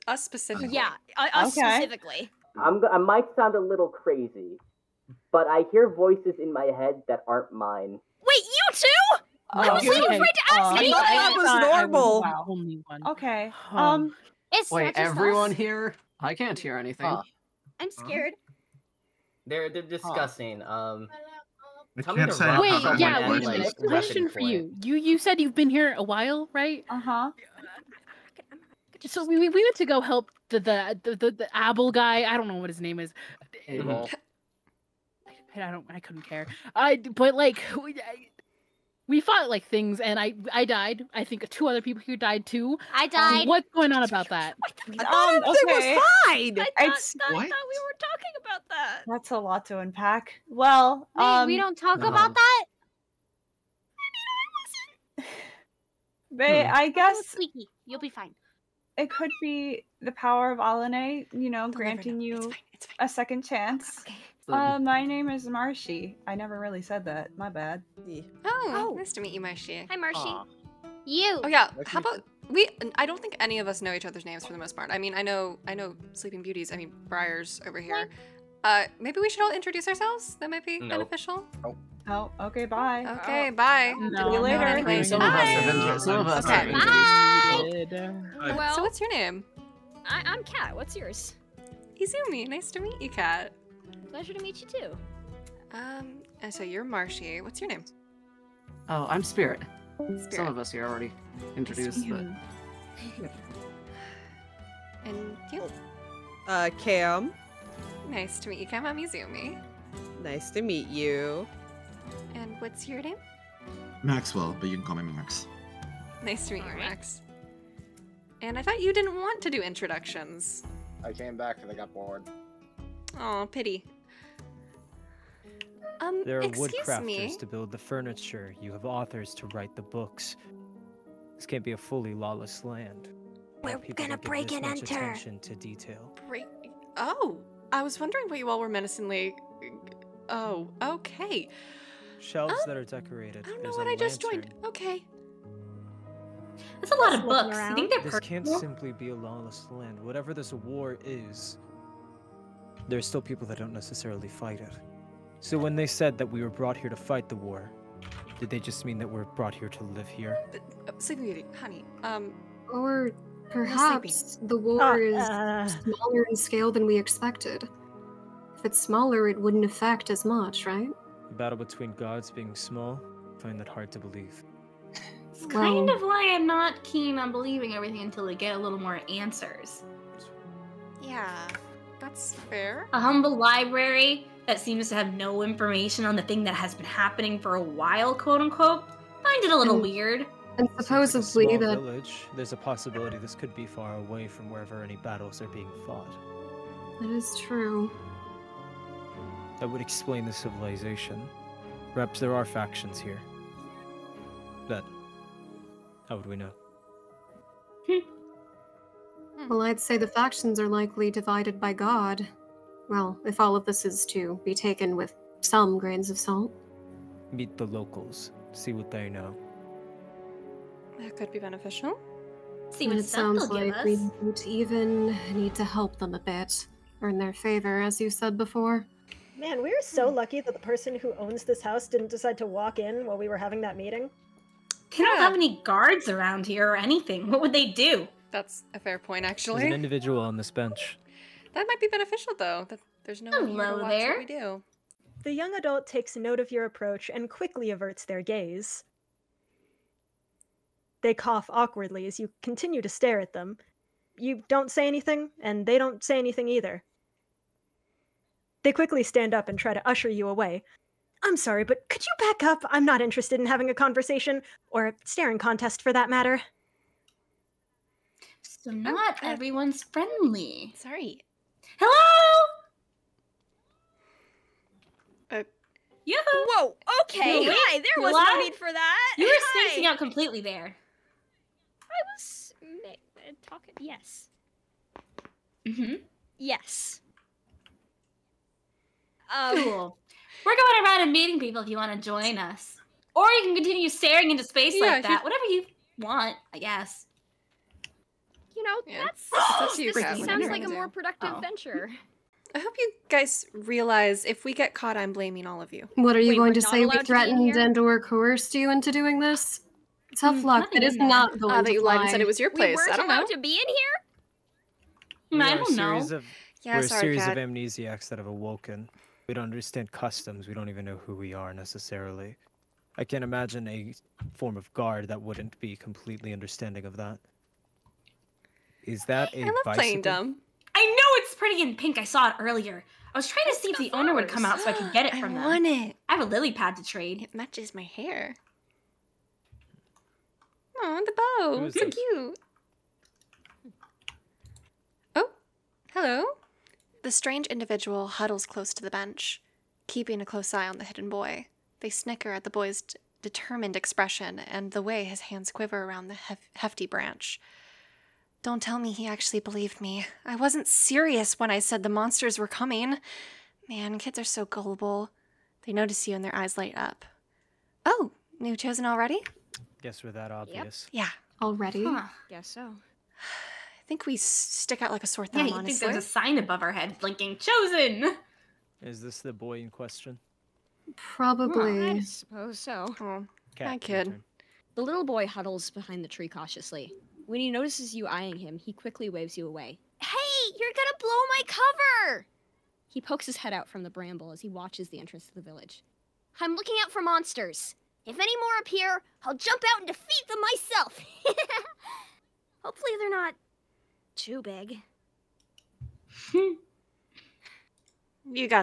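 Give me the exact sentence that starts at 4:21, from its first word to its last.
I'm sorry, but could you back up?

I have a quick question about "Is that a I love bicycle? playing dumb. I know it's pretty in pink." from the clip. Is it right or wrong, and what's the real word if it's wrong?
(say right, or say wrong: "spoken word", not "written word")
right.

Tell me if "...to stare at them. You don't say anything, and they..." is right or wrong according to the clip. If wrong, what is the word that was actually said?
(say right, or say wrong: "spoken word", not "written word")
right.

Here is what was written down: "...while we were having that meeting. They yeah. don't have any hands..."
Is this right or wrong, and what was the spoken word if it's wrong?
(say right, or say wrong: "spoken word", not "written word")
wrong: "guards", not "hands".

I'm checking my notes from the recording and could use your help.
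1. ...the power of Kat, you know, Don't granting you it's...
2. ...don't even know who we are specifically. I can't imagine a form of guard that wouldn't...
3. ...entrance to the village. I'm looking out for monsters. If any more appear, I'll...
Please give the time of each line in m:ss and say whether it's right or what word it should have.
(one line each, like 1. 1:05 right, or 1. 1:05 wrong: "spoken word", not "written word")
1. 1:00 wrong: "Alane", not "Kat"
2. 5:20 wrong: "necessarily", not "specifically"
3. 6:34 right.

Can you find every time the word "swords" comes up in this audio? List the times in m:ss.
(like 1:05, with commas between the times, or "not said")
not said.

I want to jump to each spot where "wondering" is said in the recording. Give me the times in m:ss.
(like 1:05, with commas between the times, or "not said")
2:17.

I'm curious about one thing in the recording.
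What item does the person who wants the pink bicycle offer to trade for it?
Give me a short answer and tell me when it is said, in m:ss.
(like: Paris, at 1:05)
A lily pad, at 5:36.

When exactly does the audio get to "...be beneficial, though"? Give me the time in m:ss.
4:01.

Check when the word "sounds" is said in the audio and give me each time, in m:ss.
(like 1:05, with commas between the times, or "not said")
0:03, 3:43, 5:00.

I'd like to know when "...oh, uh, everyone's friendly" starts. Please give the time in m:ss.
4:29.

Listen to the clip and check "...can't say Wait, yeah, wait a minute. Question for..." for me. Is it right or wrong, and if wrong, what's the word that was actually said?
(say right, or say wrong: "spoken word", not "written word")
right.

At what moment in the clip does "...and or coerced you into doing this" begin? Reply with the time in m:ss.
5:07.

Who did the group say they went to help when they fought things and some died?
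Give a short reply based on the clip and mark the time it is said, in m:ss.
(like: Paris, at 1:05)
Abel, at 0:33.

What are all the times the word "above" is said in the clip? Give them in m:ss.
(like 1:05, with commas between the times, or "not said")
6:16.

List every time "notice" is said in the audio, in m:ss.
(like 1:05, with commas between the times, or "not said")
6:05, 6:27.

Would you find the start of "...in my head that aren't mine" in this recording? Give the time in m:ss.
0:06.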